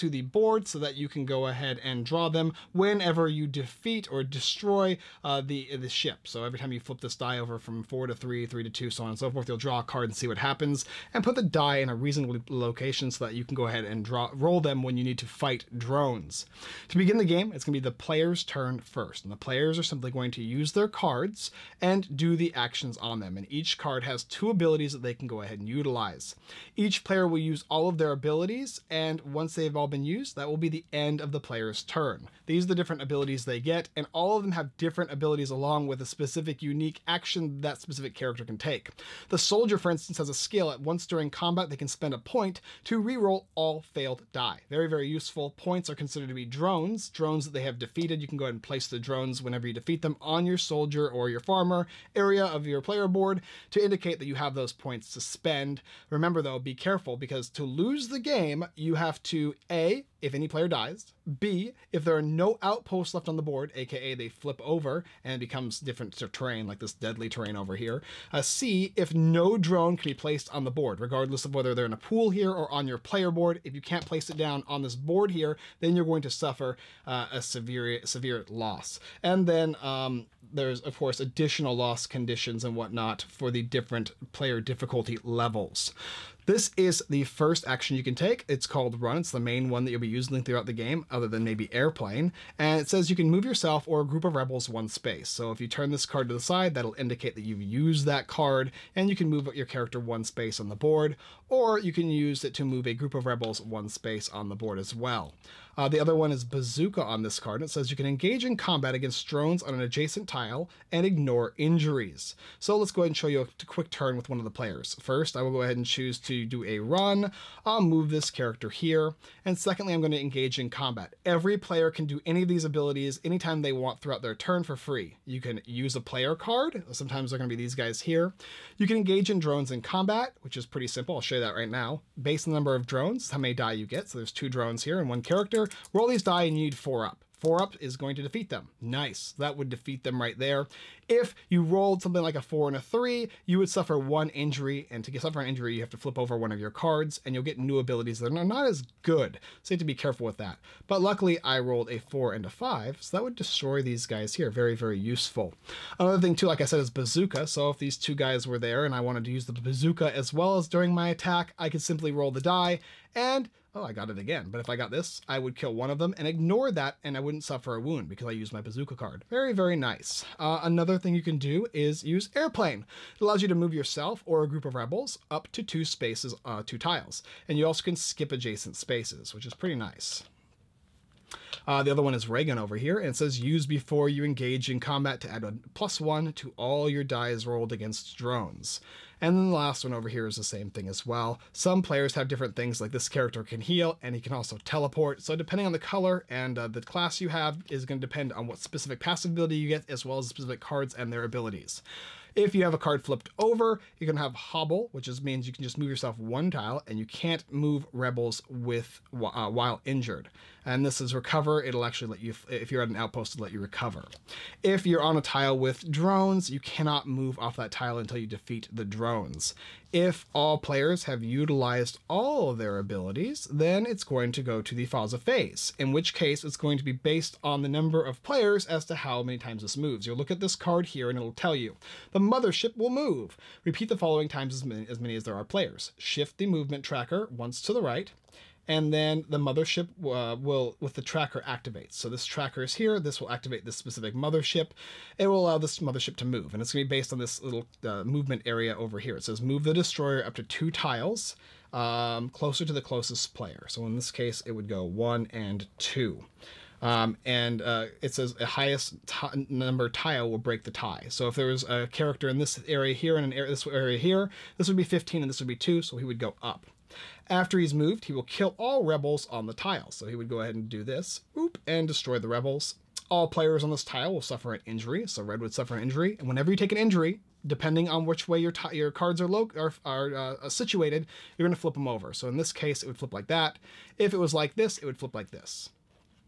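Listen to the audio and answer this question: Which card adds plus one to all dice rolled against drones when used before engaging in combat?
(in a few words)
Raygun.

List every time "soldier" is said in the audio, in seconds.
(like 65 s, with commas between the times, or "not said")
39 s, 50 s.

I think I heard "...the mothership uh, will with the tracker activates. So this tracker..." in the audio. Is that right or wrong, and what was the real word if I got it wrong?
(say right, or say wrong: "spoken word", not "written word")
right.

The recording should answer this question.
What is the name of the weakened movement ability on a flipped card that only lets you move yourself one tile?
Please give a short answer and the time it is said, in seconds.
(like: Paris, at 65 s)
Hobble, at 204 s.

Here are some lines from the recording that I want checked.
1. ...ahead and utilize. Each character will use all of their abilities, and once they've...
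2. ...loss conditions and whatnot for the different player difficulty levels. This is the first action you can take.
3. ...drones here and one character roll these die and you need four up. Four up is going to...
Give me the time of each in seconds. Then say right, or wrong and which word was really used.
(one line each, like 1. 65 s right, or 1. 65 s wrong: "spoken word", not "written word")
1. 25 s wrong: "player", not "character"
2. 81 s right
3. 134 s right.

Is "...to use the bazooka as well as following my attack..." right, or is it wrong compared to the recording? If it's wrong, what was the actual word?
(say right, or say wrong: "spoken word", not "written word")
wrong: "during", not "following".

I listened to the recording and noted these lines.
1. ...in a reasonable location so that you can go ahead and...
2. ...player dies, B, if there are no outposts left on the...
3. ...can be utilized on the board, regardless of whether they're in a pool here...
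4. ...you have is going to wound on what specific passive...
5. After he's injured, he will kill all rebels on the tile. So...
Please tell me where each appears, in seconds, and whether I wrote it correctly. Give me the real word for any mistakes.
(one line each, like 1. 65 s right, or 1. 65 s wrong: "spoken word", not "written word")
1. 11 s right
2. 60 s right
3. 69 s wrong: "placed", not "utilized"
4. 197 s wrong: "depend", not "wound"
5. 267 s wrong: "moved", not "injured".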